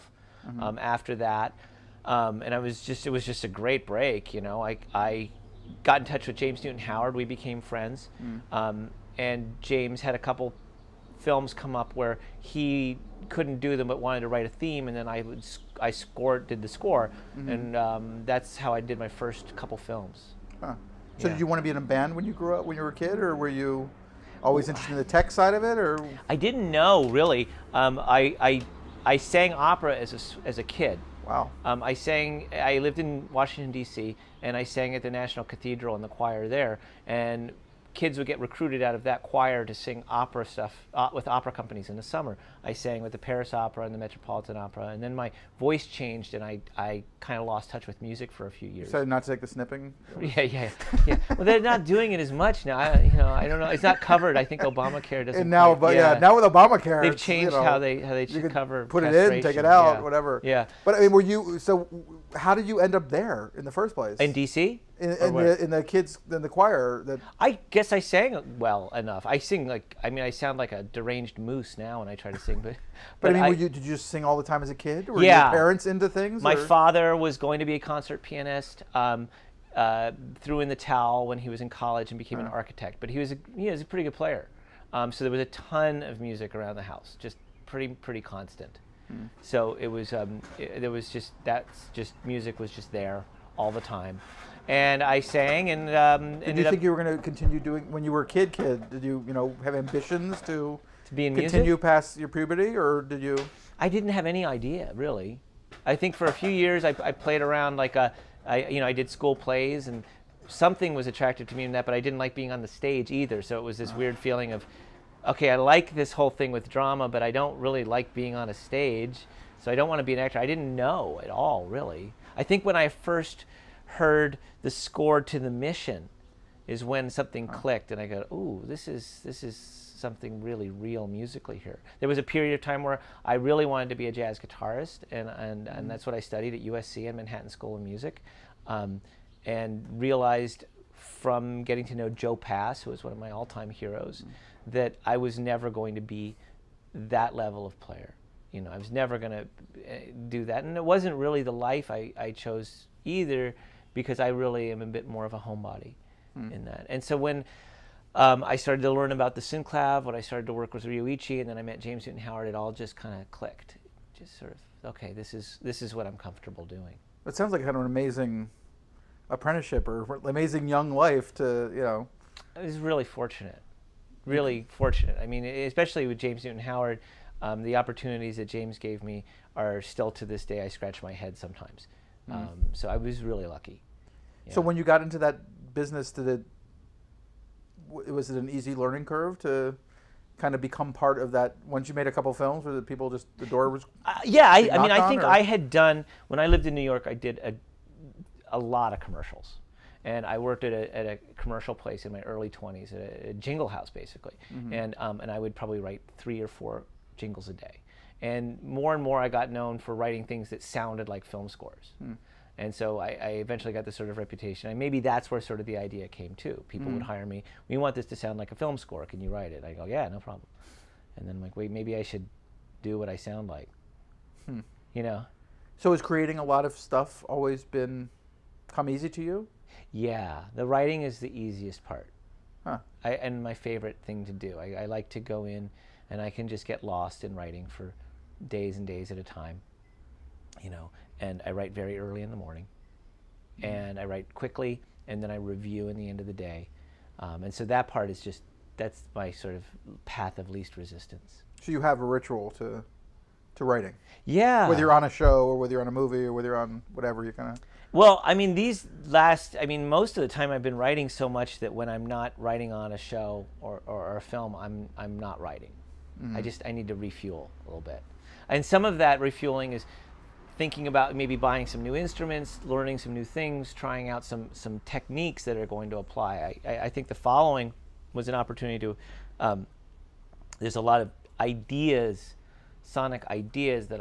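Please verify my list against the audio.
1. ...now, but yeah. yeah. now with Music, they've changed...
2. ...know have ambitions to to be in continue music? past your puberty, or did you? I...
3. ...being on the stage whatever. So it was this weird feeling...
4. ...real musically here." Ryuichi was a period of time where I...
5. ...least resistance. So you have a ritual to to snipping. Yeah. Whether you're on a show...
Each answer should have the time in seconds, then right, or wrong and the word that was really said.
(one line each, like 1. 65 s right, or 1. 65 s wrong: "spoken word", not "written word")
1. 55 s wrong: "Obamacare", not "Music"
2. 99 s right
3. 112 s wrong: "either", not "whatever"
4. 130 s wrong: "There", not "Ryuichi"
5. 250 s wrong: "writing", not "snipping".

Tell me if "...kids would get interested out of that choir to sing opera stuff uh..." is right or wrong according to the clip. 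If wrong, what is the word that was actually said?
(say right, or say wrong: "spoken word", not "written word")
wrong: "recruited", not "interested".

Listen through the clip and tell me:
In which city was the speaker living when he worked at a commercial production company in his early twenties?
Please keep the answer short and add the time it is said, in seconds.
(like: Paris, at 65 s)
New York, at 196 s.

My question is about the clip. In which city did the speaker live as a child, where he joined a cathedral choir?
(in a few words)
Washington D.C.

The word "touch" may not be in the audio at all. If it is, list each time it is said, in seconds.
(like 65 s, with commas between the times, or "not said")
6 s, 47 s.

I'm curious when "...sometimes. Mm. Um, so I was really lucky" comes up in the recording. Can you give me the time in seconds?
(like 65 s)
181 s.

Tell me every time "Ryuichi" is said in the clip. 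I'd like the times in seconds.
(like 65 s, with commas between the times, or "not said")
160 s.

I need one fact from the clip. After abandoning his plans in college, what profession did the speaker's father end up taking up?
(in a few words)
Architect.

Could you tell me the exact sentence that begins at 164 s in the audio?
just sort of okay, this is this is what I'm comfortable doing.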